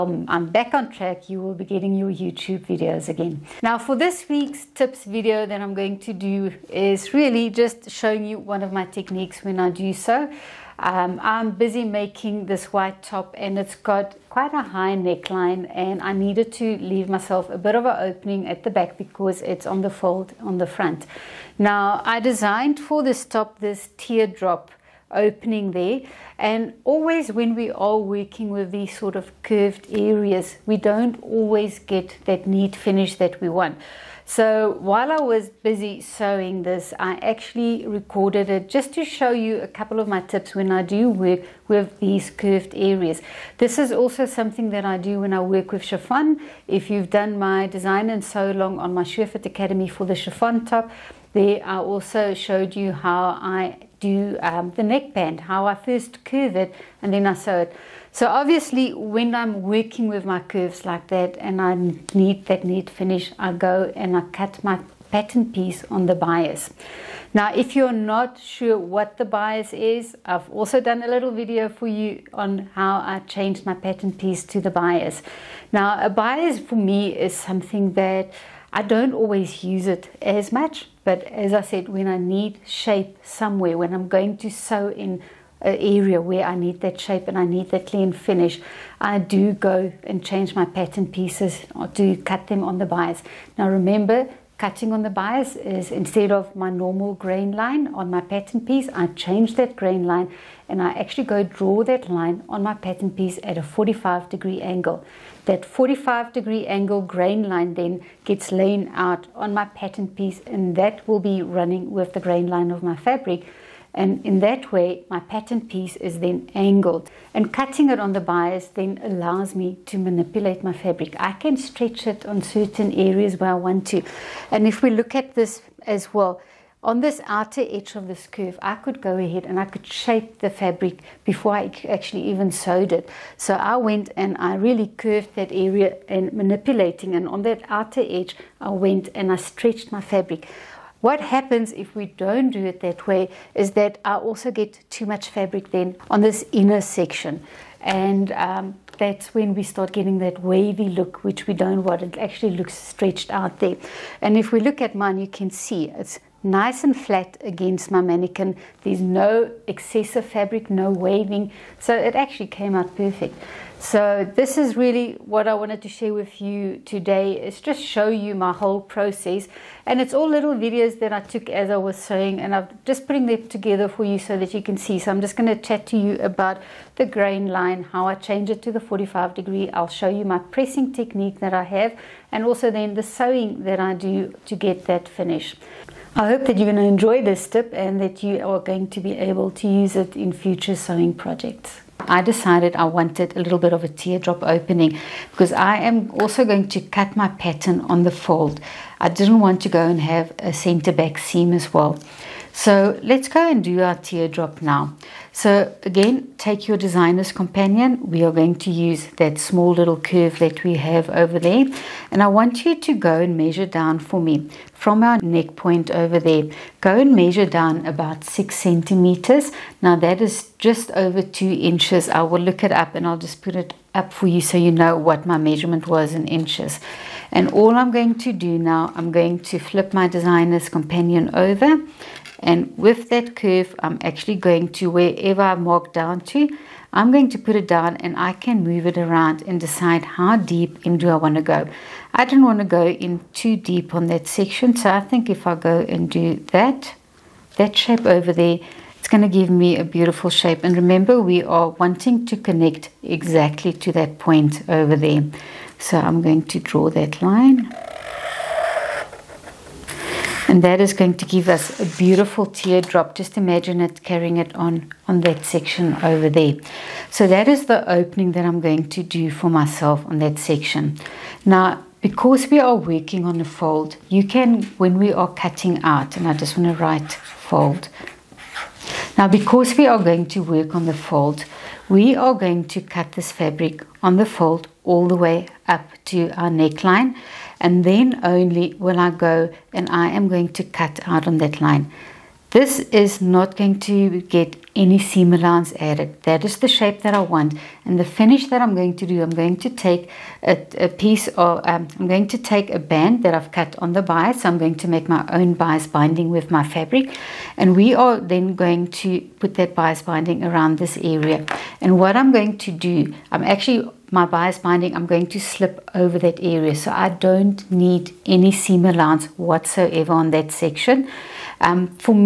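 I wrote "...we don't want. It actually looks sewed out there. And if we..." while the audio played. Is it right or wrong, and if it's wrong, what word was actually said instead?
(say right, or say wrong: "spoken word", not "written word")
wrong: "stretched", not "sewed".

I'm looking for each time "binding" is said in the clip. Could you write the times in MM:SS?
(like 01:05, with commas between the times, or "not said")
05:05, 05:10, 05:14.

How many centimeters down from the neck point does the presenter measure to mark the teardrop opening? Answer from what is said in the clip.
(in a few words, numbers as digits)
6.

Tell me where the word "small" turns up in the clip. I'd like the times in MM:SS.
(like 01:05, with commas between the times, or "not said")
03:29.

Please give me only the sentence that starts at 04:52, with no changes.
This is not going to get any seam allowance added.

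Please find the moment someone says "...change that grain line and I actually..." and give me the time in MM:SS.
01:39.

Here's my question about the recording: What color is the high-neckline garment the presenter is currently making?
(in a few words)
White.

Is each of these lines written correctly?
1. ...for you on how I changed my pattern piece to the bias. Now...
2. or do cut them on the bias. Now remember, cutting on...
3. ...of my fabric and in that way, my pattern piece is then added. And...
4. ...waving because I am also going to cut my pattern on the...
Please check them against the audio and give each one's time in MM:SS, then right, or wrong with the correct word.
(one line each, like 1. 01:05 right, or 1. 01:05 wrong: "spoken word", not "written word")
1. 01:11 right
2. 01:31 right
3. 01:52 wrong: "angled", not "added"
4. 03:14 wrong: "opening", not "waving".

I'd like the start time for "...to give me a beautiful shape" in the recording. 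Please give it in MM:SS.
04:09.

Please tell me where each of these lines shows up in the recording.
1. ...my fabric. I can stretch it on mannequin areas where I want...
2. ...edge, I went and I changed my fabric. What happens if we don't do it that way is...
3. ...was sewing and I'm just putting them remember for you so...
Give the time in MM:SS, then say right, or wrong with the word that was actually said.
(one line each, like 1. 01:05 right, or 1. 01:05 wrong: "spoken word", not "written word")
1. 02:00 wrong: "certain", not "mannequin"
2. 02:18 wrong: "stretched", not "changed"
3. 02:51 wrong: "together", not "remember".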